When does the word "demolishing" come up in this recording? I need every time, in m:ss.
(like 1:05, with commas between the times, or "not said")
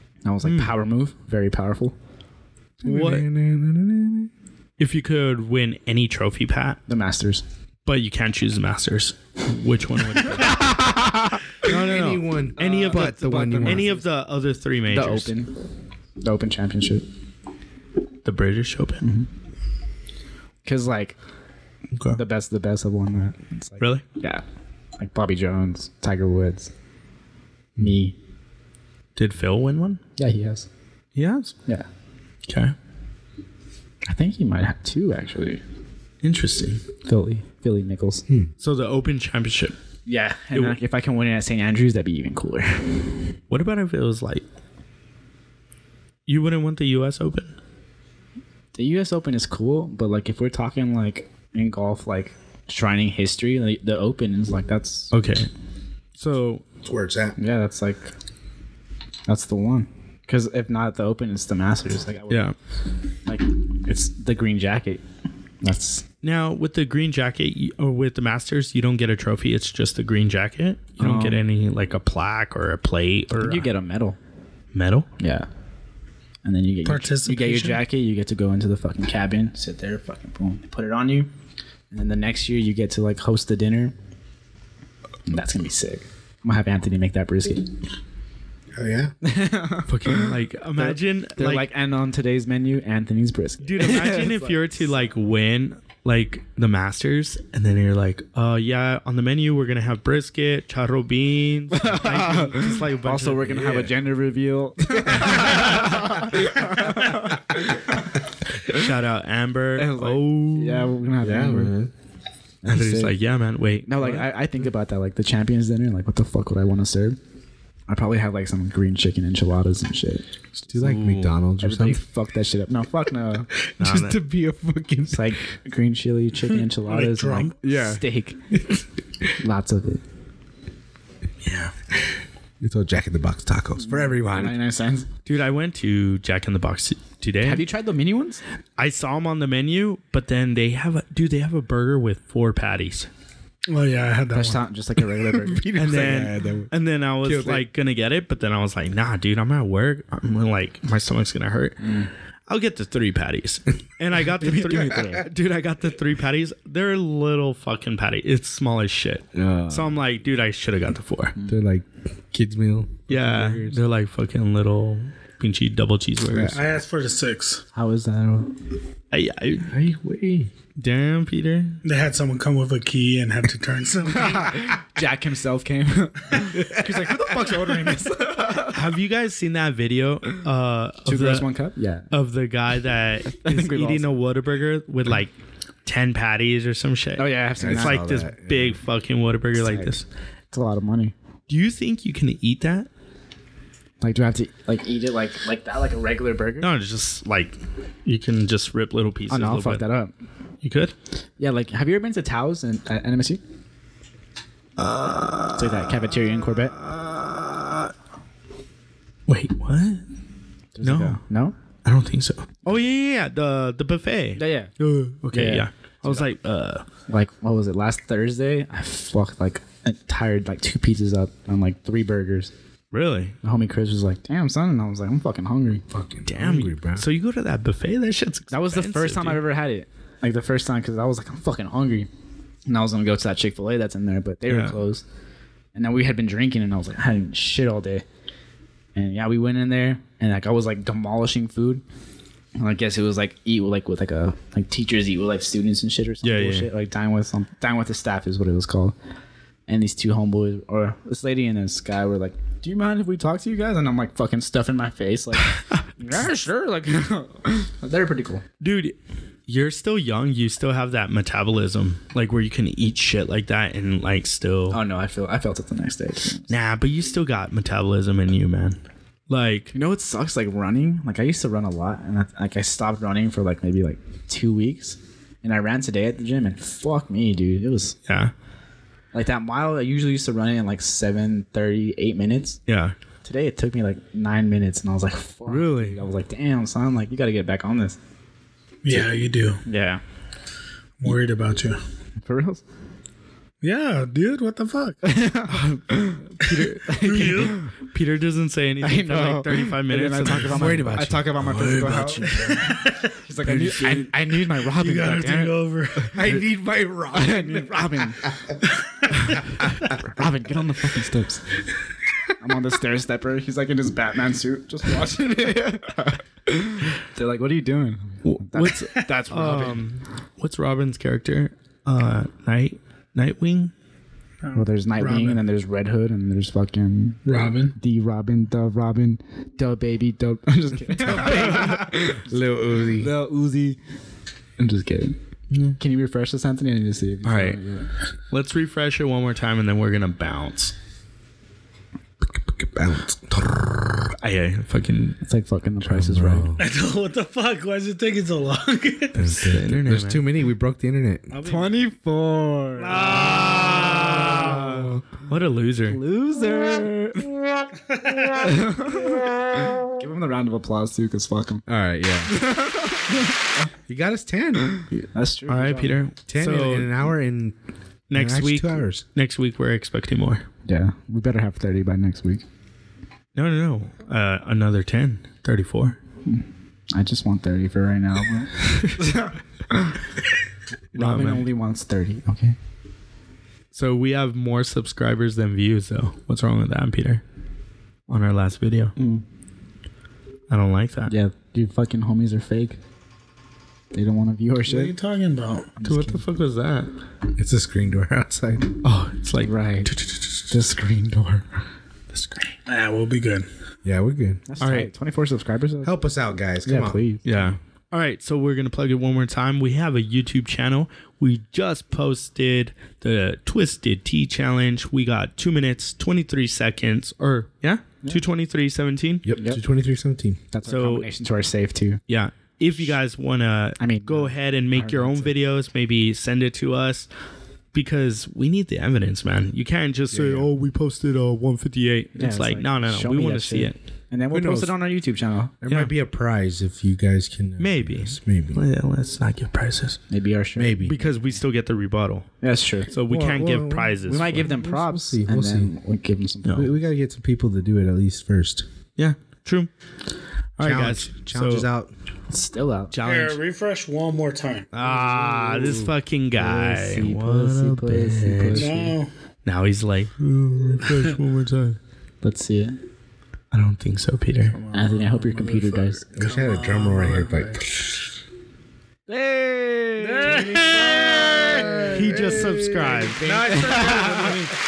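4:00.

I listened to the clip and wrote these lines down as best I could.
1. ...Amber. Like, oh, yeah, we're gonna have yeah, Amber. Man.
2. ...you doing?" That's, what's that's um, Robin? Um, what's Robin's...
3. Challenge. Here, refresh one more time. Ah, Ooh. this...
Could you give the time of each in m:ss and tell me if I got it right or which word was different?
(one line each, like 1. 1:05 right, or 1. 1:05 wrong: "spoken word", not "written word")
1. 1:49 right
2. 5:17 right
3. 7:32 right.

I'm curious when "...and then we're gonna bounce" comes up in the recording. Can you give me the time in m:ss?
5:39.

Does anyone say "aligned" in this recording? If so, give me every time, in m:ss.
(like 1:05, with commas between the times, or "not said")
not said.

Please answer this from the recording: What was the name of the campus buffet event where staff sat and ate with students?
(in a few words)
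Dine with the staff.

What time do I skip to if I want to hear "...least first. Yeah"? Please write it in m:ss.
7:27.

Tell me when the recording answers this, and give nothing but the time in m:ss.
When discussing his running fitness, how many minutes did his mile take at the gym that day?
4:44.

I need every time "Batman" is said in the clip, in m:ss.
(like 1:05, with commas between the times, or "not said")
5:13.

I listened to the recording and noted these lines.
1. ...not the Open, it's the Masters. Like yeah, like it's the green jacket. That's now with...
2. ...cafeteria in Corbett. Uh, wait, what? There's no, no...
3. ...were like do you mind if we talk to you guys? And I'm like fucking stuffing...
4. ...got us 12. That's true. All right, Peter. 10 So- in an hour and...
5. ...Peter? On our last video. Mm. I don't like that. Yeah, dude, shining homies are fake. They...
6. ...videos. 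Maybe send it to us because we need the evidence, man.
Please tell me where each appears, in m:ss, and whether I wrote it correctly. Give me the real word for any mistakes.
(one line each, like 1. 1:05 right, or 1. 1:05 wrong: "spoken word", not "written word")
1. 1:00 right
2. 3:25 right
3. 4:12 right
4. 6:03 wrong: "10", not "12"
5. 6:26 wrong: "fucking", not "shining"
6. 7:05 right.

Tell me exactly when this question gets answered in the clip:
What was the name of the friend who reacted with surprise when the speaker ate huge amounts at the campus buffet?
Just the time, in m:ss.
3:43.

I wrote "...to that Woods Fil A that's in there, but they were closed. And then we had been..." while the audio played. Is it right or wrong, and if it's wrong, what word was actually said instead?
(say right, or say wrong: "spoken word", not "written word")
wrong: "Chick", not "Woods".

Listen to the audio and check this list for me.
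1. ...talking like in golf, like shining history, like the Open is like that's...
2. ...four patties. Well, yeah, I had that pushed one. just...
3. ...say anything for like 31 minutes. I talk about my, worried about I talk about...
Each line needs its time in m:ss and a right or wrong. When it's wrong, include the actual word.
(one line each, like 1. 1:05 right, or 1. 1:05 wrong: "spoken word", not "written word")
1. 0:50 right
2. 2:22 right
3. 4:58 wrong: "35", not "31".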